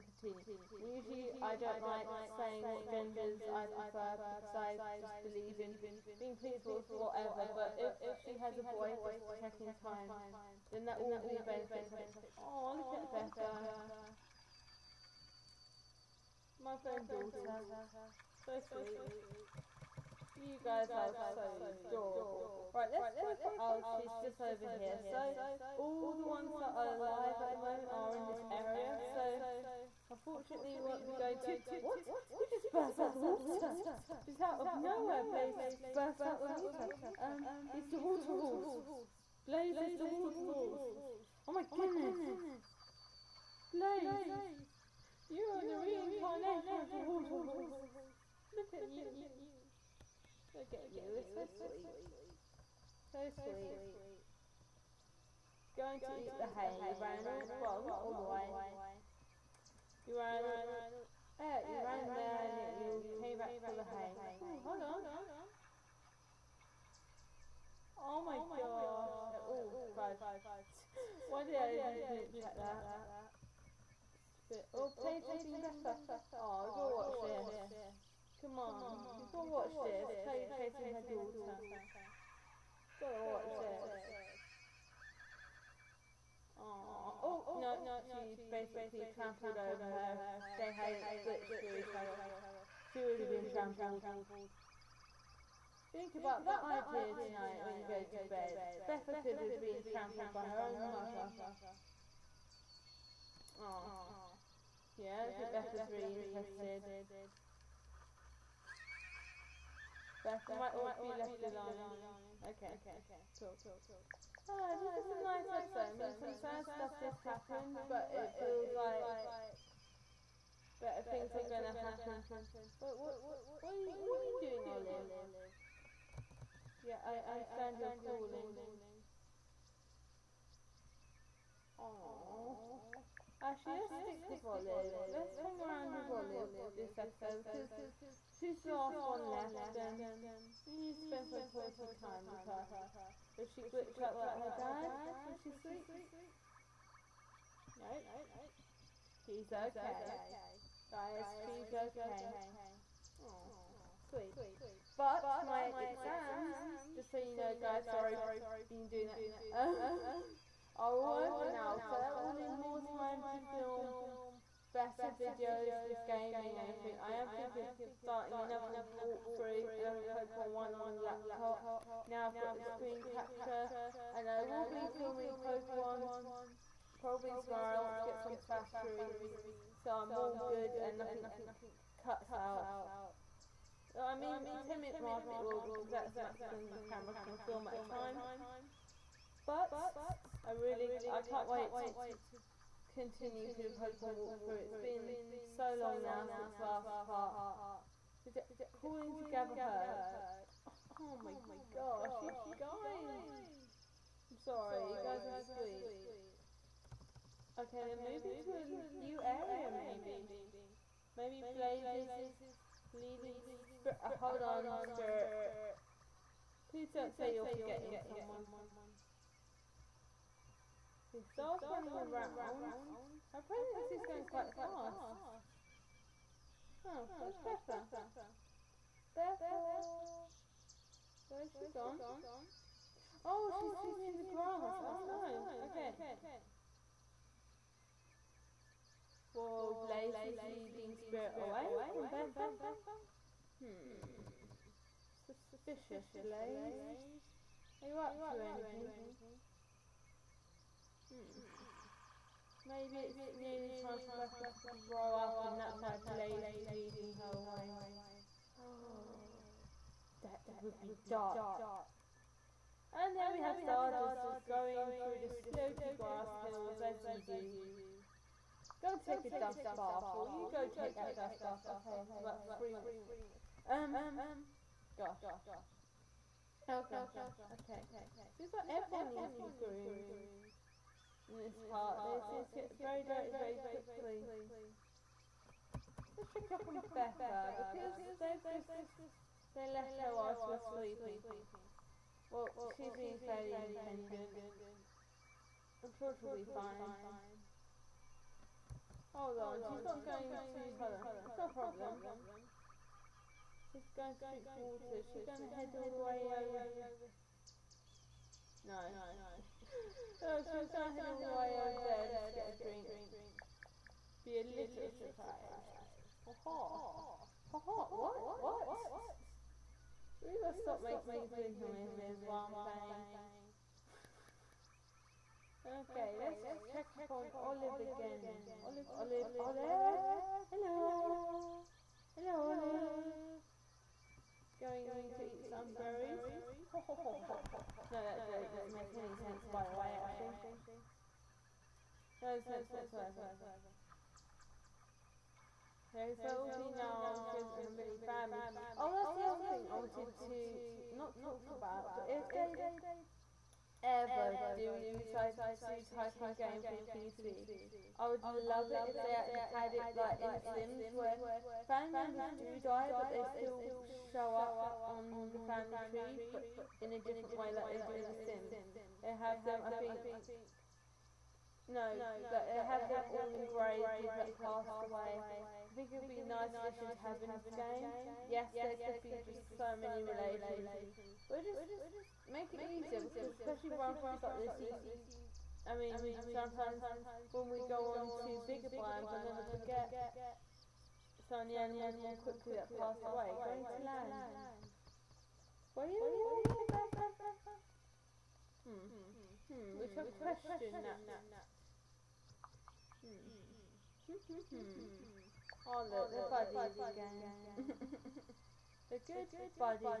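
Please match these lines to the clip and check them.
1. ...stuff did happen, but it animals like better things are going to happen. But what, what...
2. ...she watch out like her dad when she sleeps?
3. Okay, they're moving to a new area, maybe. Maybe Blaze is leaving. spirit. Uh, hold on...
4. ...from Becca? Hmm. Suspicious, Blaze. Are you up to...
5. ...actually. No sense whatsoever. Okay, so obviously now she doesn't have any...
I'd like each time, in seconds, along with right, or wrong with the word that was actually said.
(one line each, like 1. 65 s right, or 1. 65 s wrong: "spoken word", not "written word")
1. 116 s wrong: "feels", not "animals"
2. 143 s wrong: "glitch", not "watch"
3. 207 s right
4. 241 s wrong: "Bethel", not "Becca"
5. 340 s right.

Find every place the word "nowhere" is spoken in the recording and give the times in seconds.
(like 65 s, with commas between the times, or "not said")
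34 s.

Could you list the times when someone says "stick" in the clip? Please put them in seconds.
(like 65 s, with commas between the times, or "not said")
134 s.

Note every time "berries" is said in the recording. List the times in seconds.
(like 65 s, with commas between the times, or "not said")
335 s.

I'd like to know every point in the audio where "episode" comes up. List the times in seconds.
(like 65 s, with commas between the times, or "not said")
115 s, 136 s.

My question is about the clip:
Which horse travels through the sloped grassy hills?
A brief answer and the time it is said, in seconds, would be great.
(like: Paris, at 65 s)
Stardust, at 263 s.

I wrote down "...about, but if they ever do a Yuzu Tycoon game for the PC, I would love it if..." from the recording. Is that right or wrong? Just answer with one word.
right.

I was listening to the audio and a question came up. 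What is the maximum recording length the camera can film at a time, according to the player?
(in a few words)
10 minutes.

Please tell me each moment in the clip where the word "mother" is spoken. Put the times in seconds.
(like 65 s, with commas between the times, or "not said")
16 s, 100 s.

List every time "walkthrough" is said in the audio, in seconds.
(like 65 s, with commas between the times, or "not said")
168 s, 194 s.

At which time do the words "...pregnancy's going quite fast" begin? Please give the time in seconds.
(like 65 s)
223 s.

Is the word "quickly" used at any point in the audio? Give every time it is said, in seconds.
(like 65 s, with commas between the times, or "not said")
283 s, 392 s.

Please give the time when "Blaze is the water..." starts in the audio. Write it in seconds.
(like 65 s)
39 s.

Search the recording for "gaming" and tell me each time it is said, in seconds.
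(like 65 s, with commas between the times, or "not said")
166 s.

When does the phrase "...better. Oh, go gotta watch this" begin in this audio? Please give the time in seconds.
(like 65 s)
75 s.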